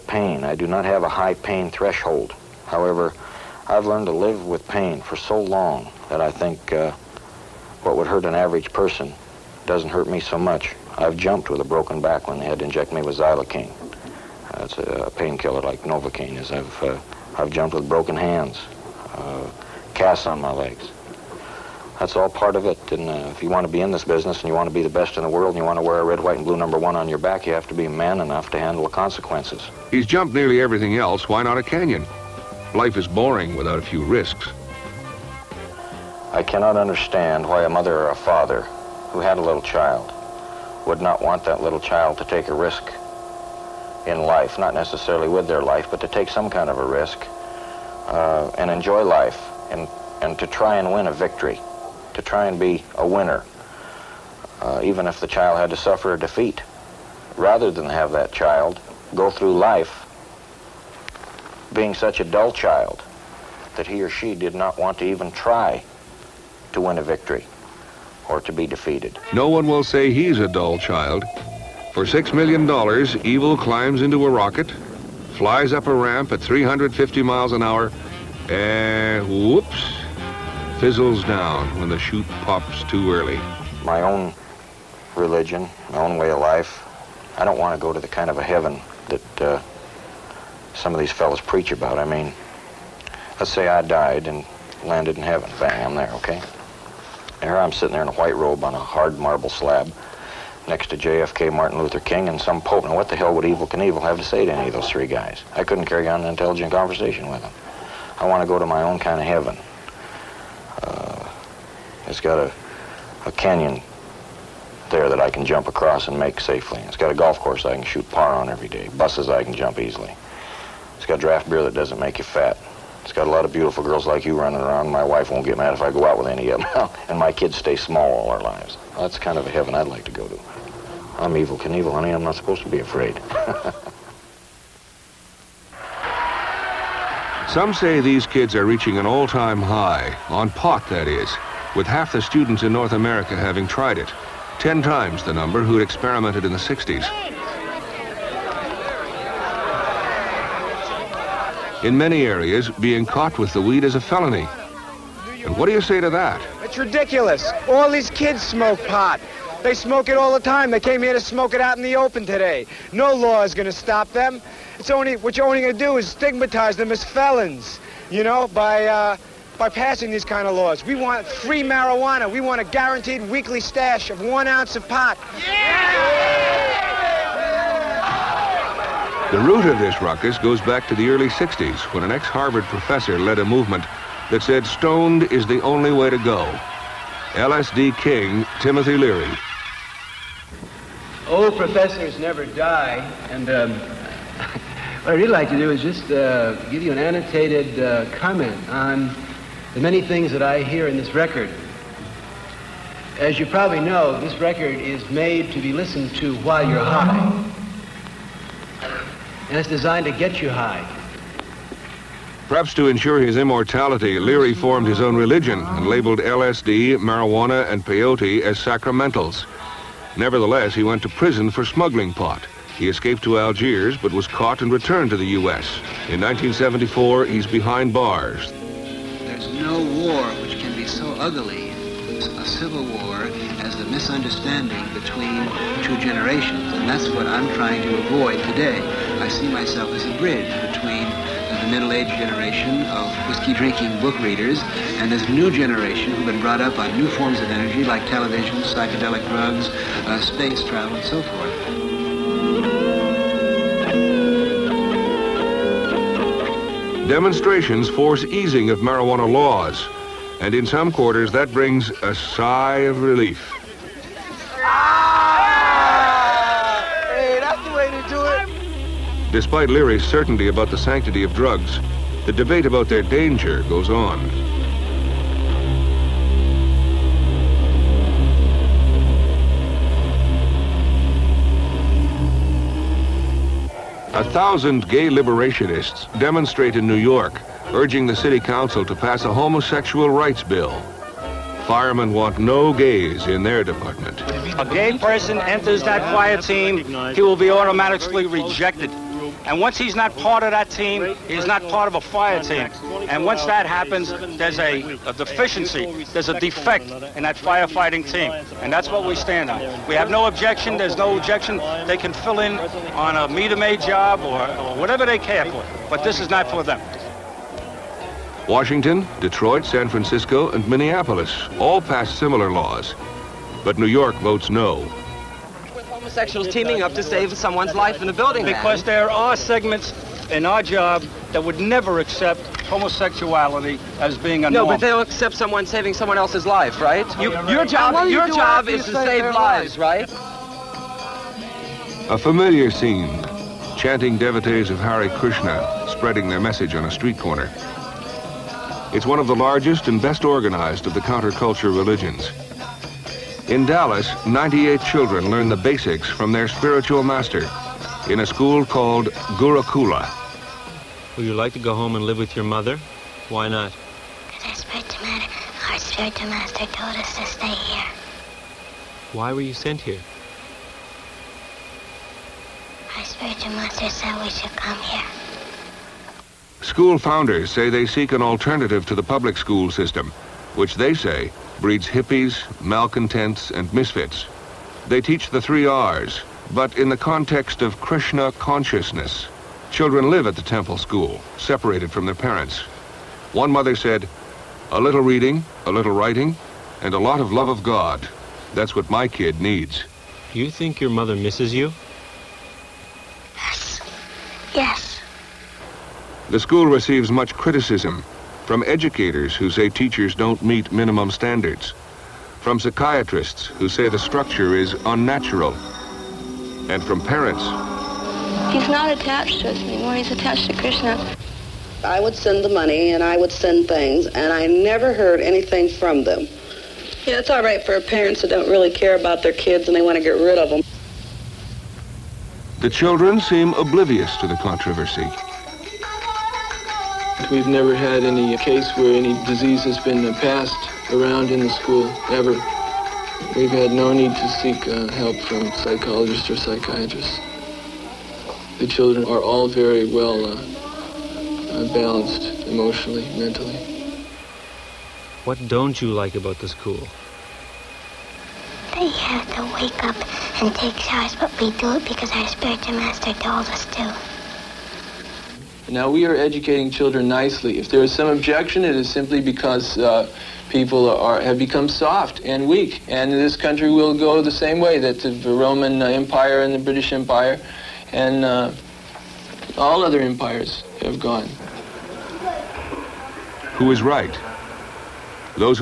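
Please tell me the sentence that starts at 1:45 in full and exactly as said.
I couldn't carry on an intelligent conversation with them.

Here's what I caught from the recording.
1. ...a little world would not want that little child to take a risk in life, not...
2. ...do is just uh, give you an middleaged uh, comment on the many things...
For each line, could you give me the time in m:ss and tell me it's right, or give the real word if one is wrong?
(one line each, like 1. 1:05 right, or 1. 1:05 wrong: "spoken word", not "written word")
1. 0:39 wrong: "child", not "world"
2. 3:15 wrong: "annotated", not "middleaged".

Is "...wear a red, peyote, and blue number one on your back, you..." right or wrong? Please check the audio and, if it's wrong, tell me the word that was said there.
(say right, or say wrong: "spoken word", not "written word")
wrong: "white", not "peyote".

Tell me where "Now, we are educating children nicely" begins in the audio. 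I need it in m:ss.
7:45.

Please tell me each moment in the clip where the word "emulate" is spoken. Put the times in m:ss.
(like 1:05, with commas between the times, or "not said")
not said.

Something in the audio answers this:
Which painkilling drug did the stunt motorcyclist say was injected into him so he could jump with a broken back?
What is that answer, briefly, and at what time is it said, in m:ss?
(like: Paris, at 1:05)
xylocaine, at 0:13.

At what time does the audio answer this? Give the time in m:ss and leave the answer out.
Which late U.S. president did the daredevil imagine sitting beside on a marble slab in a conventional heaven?
1:40.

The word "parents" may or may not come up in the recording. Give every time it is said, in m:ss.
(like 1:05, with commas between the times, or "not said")
6:32, 6:56, 7:07.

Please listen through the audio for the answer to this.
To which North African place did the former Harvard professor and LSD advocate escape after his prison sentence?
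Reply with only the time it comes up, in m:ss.
3:43.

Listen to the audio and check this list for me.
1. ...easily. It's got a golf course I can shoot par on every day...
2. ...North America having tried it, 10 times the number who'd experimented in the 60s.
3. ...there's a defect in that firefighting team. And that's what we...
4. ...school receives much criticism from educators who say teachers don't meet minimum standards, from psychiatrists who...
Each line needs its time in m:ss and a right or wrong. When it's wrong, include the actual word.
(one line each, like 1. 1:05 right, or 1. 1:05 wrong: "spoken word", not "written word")
1. 1:56 wrong: "safely", not "easily"
2. 2:22 right
3. 5:06 right
4. 6:46 right.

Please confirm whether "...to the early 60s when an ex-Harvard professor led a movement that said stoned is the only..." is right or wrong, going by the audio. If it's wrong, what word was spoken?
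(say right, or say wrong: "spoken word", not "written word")
right.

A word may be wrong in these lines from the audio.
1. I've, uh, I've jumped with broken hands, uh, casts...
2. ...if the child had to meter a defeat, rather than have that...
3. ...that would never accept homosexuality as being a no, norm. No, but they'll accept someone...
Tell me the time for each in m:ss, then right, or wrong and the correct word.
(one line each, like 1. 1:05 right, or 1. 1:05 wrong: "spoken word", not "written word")
1. 0:16 right
2. 0:55 wrong: "suffer", not "meter"
3. 5:31 right.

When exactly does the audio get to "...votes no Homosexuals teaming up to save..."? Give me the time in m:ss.
5:24.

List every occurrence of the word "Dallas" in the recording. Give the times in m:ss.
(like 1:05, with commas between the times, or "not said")
5:53.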